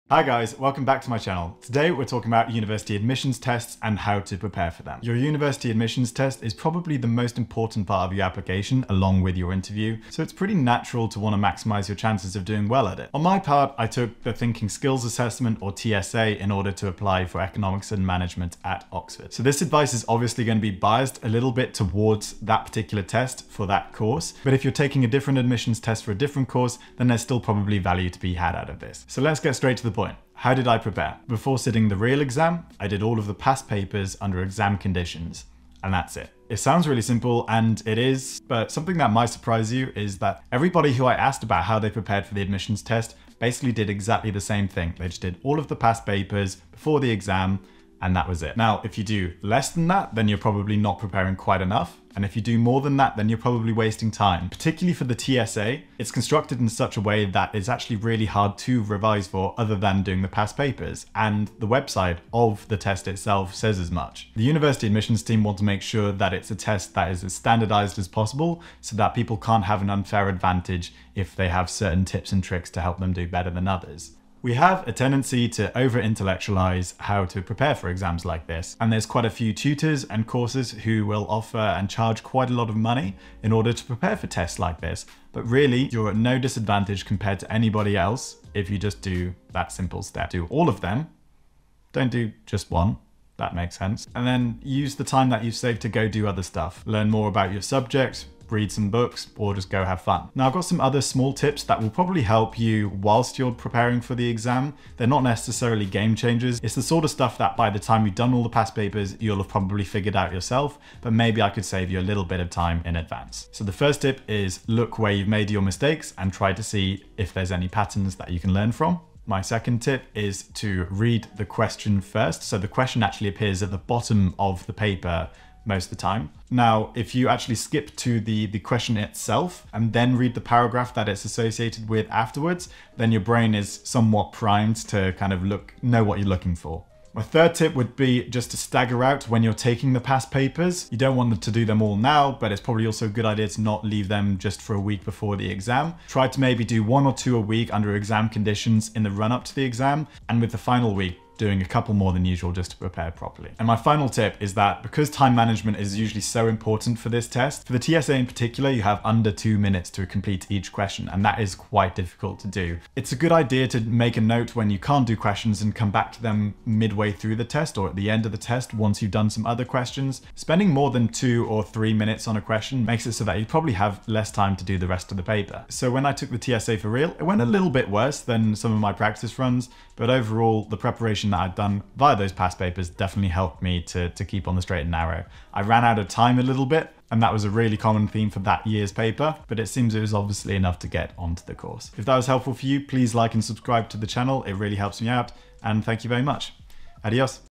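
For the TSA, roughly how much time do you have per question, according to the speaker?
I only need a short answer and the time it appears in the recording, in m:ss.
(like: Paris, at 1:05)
Under 2 minutes, at 2:39.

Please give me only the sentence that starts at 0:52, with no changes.
And if you do more than that, then you're probably wasting time.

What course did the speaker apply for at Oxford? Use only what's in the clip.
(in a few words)
Economics and management.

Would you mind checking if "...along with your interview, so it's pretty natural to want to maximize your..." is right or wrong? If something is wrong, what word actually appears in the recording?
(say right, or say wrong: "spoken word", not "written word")
right.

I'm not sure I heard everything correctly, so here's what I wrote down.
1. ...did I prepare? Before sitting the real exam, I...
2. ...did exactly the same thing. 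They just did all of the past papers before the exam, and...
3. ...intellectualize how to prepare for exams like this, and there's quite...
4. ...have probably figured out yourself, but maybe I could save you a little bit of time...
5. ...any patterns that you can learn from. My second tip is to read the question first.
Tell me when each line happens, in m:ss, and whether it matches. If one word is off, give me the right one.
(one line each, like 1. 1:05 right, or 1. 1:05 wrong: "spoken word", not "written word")
1. 0:30 right
2. 0:43 right
3. 1:16 right
4. 1:49 right
5. 1:57 right.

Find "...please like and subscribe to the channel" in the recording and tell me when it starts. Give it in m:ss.
3:12.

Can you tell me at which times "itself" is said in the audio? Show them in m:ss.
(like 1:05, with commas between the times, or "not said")
1:03, 2:08.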